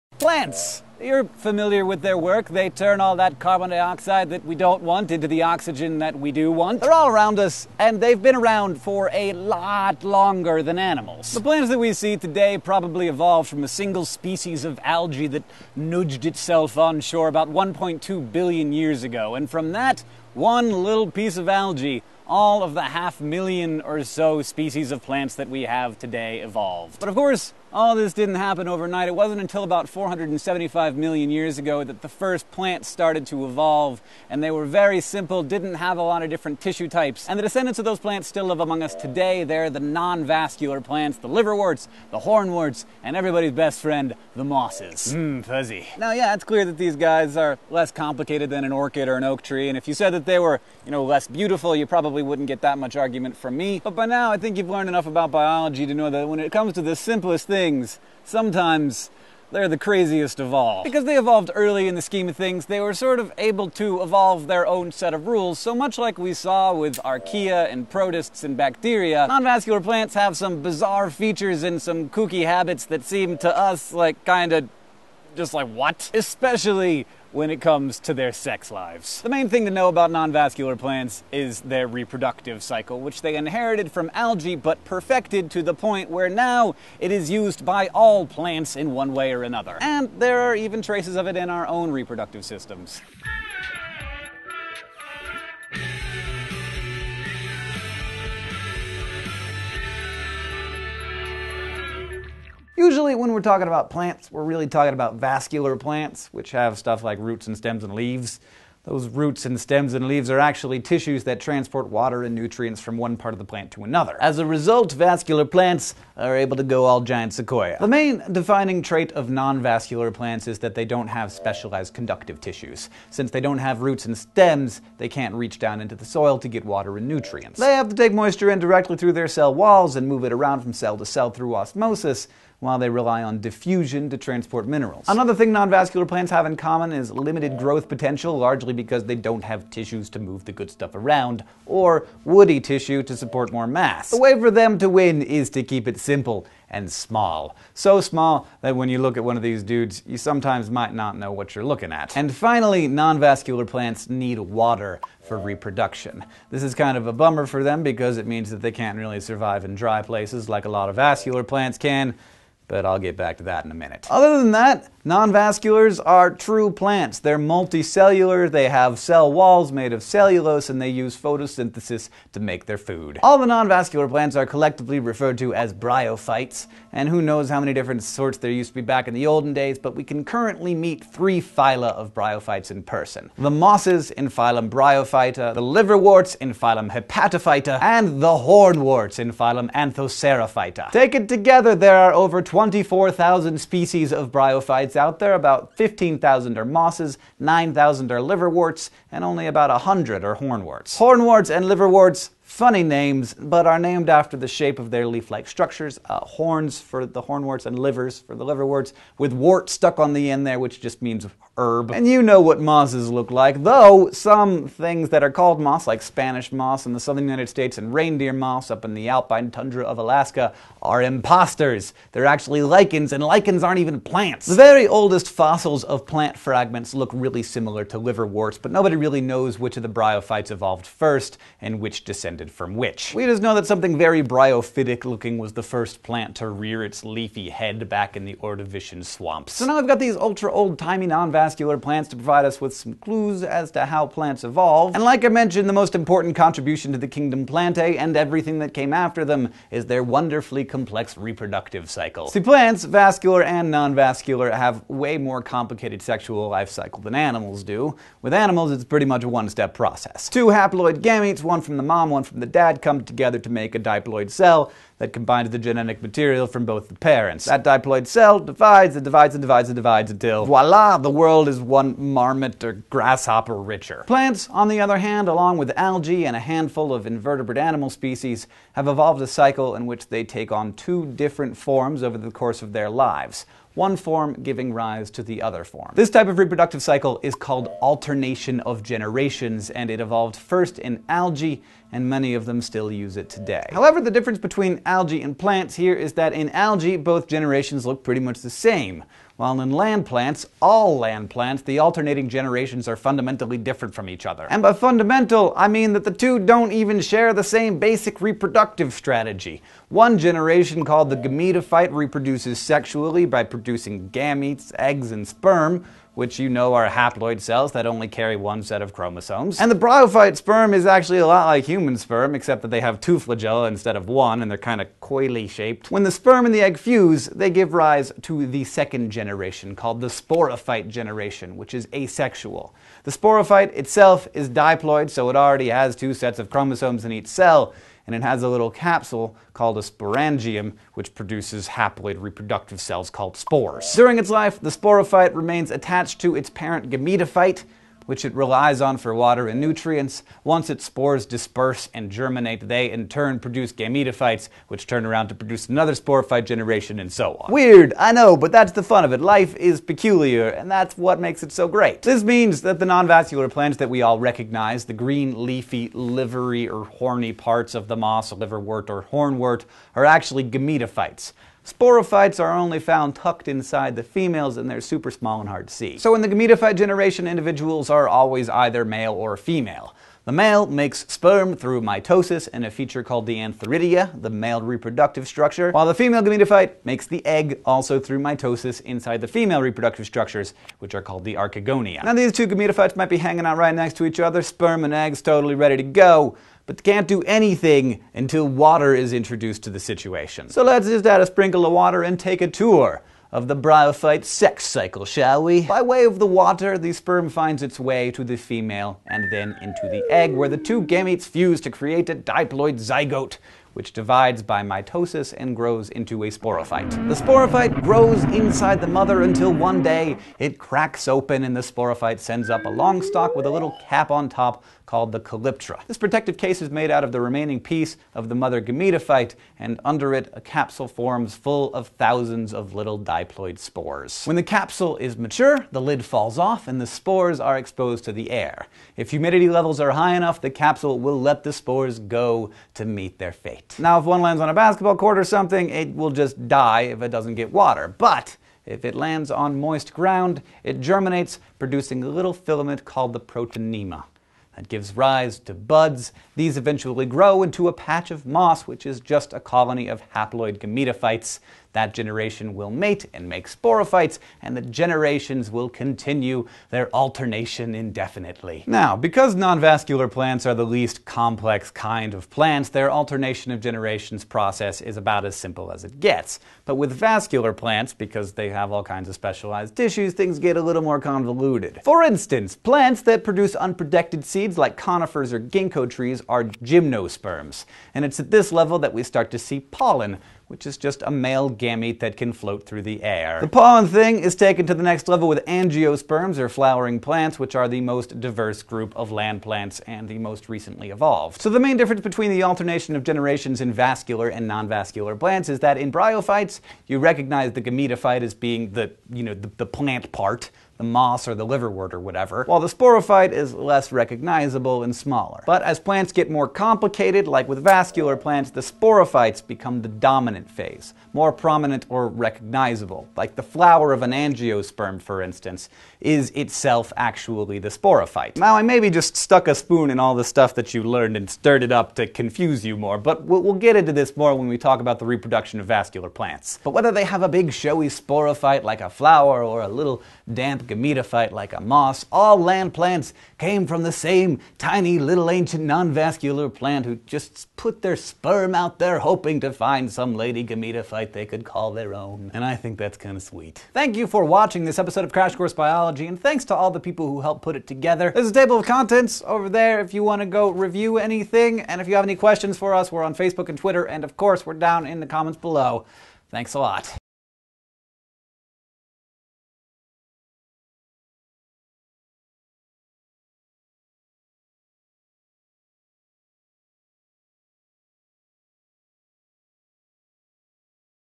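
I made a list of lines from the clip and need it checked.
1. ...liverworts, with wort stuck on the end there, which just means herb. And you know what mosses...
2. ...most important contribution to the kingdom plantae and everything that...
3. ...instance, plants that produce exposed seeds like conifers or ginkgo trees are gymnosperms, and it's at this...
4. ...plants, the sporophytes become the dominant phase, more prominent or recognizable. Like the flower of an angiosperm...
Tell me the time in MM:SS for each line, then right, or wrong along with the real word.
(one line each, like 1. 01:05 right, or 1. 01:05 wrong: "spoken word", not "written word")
1. 03:28 right
2. 04:05 right
3. 08:02 wrong: "unprotected", not "exposed"
4. 08:38 right.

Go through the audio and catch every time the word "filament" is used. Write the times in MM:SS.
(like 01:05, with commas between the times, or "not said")
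07:32.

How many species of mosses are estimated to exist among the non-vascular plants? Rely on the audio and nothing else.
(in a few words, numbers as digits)
15,000.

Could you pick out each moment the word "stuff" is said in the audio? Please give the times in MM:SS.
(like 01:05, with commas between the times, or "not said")
01:46, 02:20, 08:50.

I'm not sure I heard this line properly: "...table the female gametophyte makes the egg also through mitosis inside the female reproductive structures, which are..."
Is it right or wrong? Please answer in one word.
wrong.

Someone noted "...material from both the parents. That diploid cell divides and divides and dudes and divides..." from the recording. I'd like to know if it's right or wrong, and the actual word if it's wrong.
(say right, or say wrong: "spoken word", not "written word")
wrong: "divides", not "dudes".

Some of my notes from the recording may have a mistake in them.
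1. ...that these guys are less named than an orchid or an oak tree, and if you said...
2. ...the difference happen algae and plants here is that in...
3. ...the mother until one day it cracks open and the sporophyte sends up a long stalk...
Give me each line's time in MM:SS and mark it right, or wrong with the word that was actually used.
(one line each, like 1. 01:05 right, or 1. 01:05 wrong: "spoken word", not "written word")
1. 00:46 wrong: "complicated", not "named"
2. 04:54 wrong: "between", not "happen"
3. 06:58 right.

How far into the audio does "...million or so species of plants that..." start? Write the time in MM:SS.
00:23.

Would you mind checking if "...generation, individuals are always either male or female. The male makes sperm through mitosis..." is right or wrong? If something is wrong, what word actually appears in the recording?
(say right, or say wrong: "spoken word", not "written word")
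right.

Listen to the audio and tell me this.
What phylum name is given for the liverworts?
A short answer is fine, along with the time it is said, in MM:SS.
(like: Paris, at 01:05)
Hepatophyta, at 03:06.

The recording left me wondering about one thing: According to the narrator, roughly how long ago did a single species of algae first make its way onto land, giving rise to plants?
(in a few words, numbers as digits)
1.2 billion years ago.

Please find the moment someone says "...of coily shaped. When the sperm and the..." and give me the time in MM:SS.
05:24.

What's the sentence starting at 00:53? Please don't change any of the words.
But by now, I think you've learned enough about biology to know that when it comes to the simplest thing, things.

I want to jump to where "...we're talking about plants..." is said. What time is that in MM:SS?
01:43.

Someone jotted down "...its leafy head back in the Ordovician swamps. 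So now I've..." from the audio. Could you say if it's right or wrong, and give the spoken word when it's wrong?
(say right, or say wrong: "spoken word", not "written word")
right.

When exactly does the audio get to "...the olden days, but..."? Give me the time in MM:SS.
02:59.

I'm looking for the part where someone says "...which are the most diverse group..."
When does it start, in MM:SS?
08:17.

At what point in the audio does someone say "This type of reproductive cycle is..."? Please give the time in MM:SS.
04:45.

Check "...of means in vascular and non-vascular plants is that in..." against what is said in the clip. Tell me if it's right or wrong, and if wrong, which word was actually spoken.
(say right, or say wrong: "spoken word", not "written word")
wrong: "generations", not "means".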